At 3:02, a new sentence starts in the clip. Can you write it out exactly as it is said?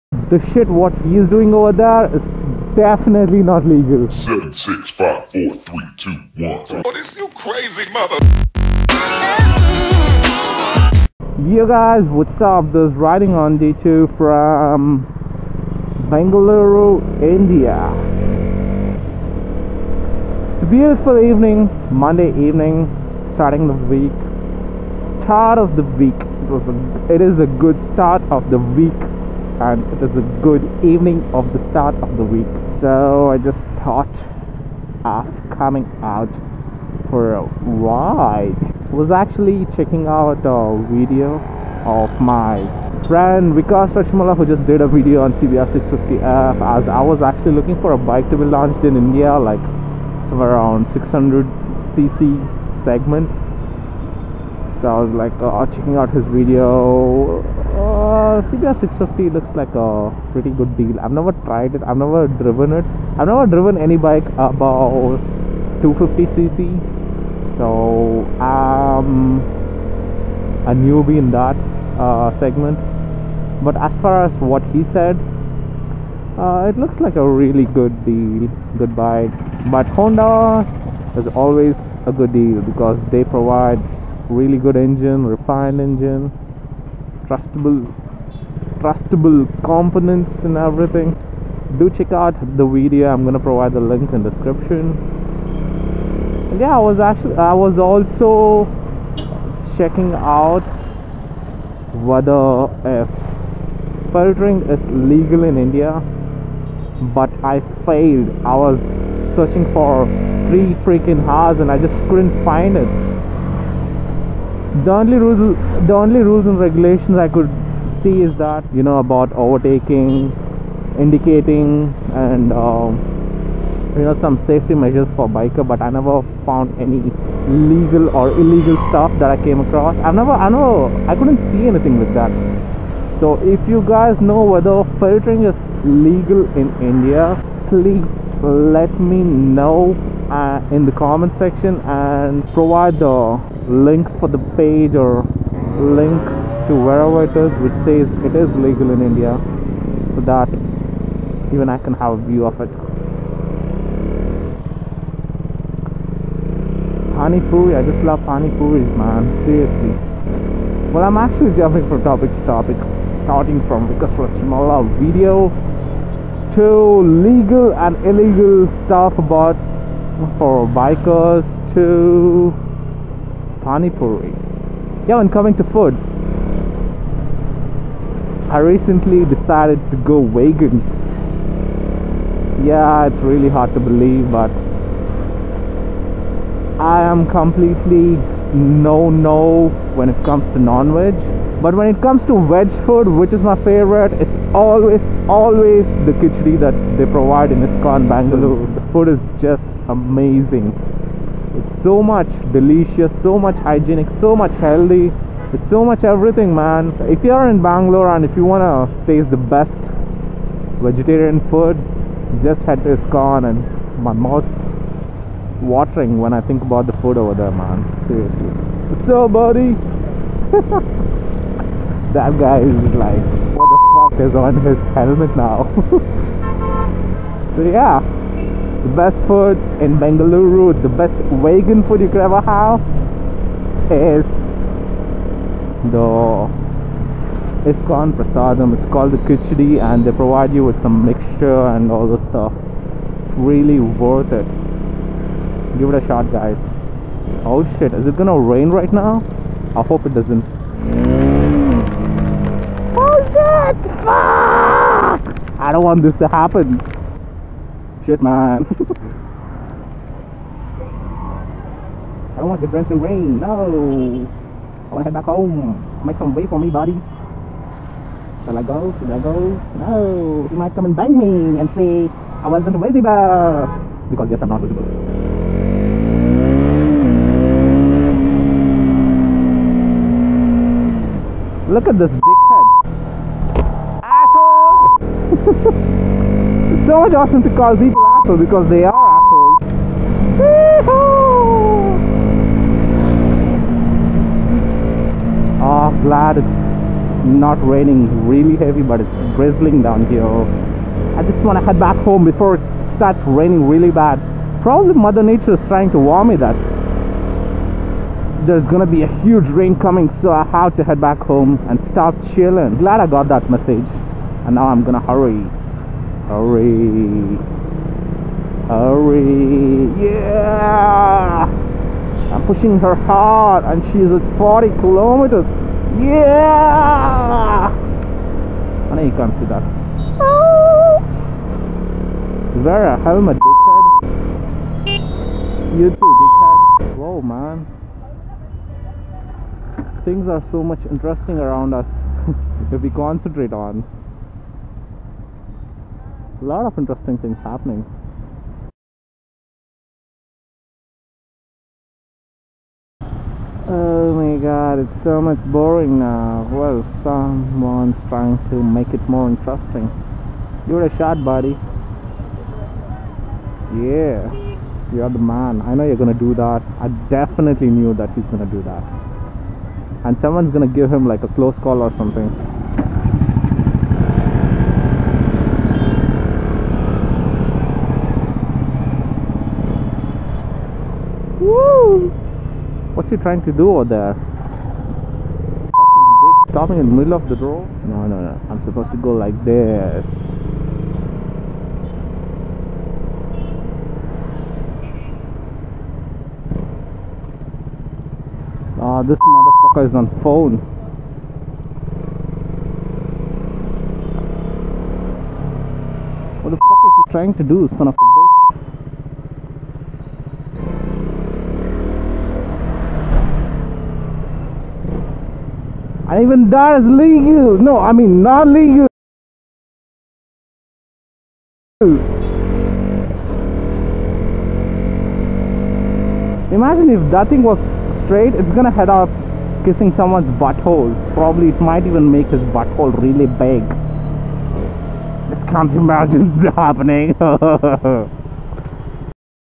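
Yeah, it's really hard to believe, but I am completely no no when it comes to non veg.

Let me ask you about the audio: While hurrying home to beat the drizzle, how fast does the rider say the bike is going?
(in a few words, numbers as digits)
40 km/h.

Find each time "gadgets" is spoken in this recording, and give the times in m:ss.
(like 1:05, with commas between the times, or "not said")
not said.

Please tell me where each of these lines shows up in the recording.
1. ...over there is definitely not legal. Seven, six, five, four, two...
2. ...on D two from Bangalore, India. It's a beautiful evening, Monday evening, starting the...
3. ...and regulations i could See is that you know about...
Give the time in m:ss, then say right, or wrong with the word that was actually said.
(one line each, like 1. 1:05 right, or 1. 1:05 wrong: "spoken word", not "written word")
1. 0:01 wrong: "three", not "two"
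2. 0:13 right
3. 1:56 right.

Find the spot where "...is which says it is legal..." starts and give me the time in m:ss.
2:27.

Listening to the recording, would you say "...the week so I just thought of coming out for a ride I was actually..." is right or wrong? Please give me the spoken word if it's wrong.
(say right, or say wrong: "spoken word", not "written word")
right.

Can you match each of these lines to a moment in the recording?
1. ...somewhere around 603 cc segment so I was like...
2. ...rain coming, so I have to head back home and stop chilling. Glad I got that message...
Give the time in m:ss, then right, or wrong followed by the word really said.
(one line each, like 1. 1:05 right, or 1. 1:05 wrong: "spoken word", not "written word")
1. 0:50 wrong: "600", not "603"
2. 5:09 right.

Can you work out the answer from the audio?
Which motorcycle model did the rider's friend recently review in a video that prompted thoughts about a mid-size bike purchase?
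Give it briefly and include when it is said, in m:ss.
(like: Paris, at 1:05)
CBR 650F, at 0:45.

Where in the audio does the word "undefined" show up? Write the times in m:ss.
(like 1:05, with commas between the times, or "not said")
not said.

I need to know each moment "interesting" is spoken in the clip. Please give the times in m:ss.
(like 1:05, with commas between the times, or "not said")
5:40, 5:46, 5:59.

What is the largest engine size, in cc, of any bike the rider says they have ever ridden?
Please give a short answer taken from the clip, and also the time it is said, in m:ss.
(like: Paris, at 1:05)
250cc, at 1:05.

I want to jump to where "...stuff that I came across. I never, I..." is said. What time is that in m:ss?
2:08.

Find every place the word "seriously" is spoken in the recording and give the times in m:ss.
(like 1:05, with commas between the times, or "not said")
2:39, 3:38.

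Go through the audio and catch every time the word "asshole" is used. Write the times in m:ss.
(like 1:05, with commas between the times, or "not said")
4:44, 4:48.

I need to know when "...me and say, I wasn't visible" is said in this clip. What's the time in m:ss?
4:31.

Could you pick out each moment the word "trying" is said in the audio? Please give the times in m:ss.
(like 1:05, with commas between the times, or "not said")
5:05, 5:58, 6:23, 6:47.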